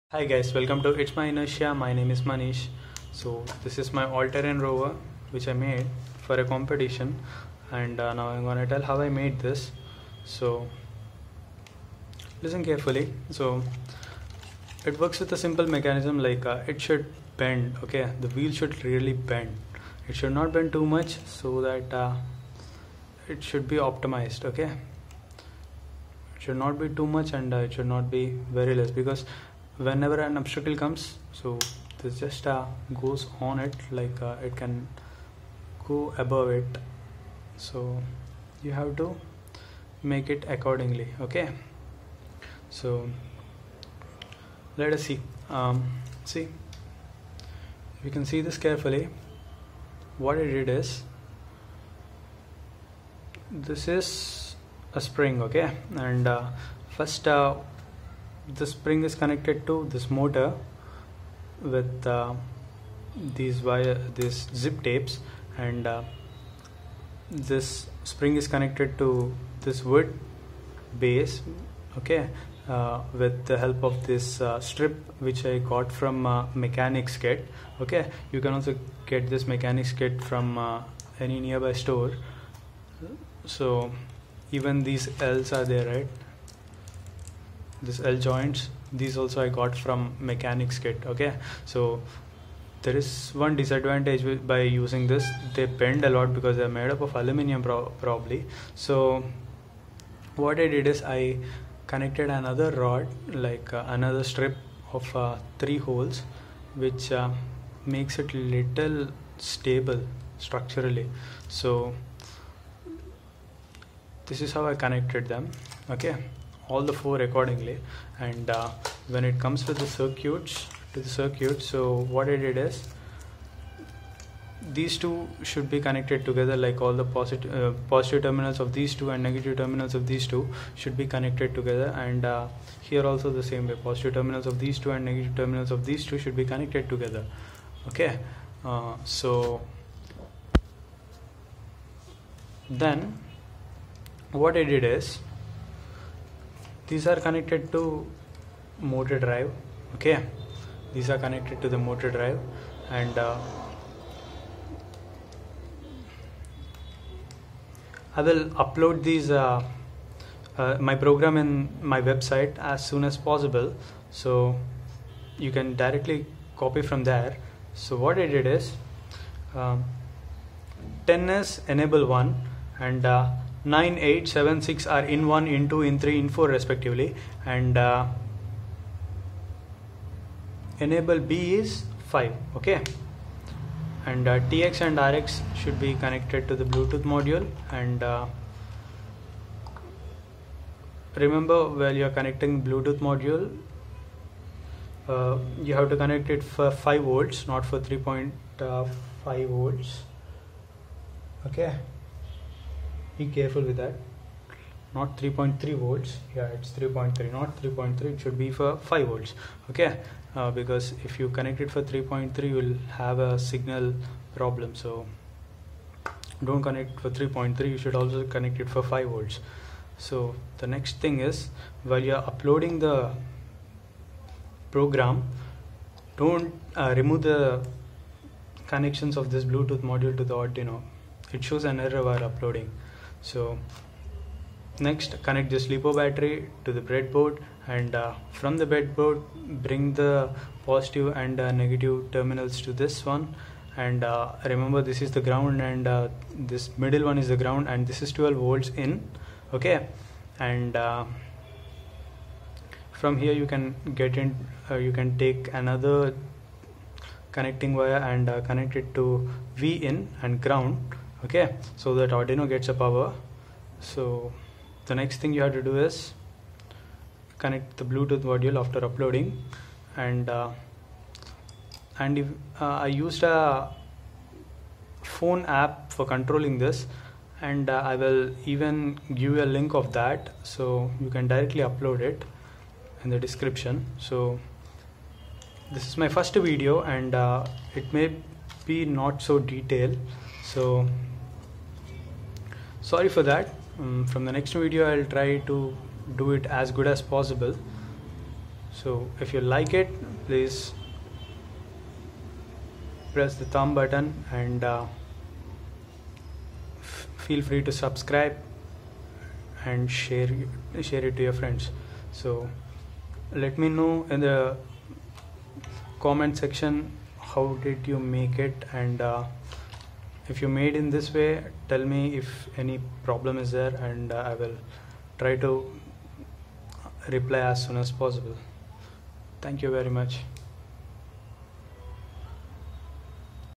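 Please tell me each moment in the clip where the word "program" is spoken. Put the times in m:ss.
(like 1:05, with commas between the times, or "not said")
2:40, 3:44.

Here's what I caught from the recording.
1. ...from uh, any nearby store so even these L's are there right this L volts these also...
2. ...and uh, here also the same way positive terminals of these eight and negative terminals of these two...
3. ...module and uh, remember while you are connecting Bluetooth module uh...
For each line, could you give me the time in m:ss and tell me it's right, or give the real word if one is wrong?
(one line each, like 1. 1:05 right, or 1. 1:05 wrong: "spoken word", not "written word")
1. 1:20 wrong: "joints", not "volts"
2. 2:11 wrong: "two", not "eight"
3. 3:07 right.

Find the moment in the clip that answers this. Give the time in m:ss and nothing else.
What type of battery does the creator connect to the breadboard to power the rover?
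3:55.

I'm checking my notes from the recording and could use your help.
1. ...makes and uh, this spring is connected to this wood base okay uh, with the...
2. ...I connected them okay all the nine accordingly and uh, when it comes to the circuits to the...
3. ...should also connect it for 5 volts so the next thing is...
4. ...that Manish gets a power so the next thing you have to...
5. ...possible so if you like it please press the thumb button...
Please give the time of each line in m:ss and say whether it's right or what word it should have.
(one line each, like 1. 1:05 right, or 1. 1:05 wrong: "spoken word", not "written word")
1. 1:04 wrong: "tapes", not "makes"
2. 1:54 wrong: "four", not "nine"
3. 3:37 right
4. 4:21 wrong: "Arduino", not "Manish"
5. 4:57 right.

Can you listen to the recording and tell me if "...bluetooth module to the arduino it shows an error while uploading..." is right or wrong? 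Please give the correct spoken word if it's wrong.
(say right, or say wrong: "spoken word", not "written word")
right.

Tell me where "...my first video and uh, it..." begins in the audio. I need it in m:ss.
4:45.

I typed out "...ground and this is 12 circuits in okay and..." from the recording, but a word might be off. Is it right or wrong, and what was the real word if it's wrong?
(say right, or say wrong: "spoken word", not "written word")
wrong: "volts", not "circuits".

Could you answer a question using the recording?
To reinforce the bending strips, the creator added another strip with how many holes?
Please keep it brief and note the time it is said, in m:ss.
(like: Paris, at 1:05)
3, at 1:45.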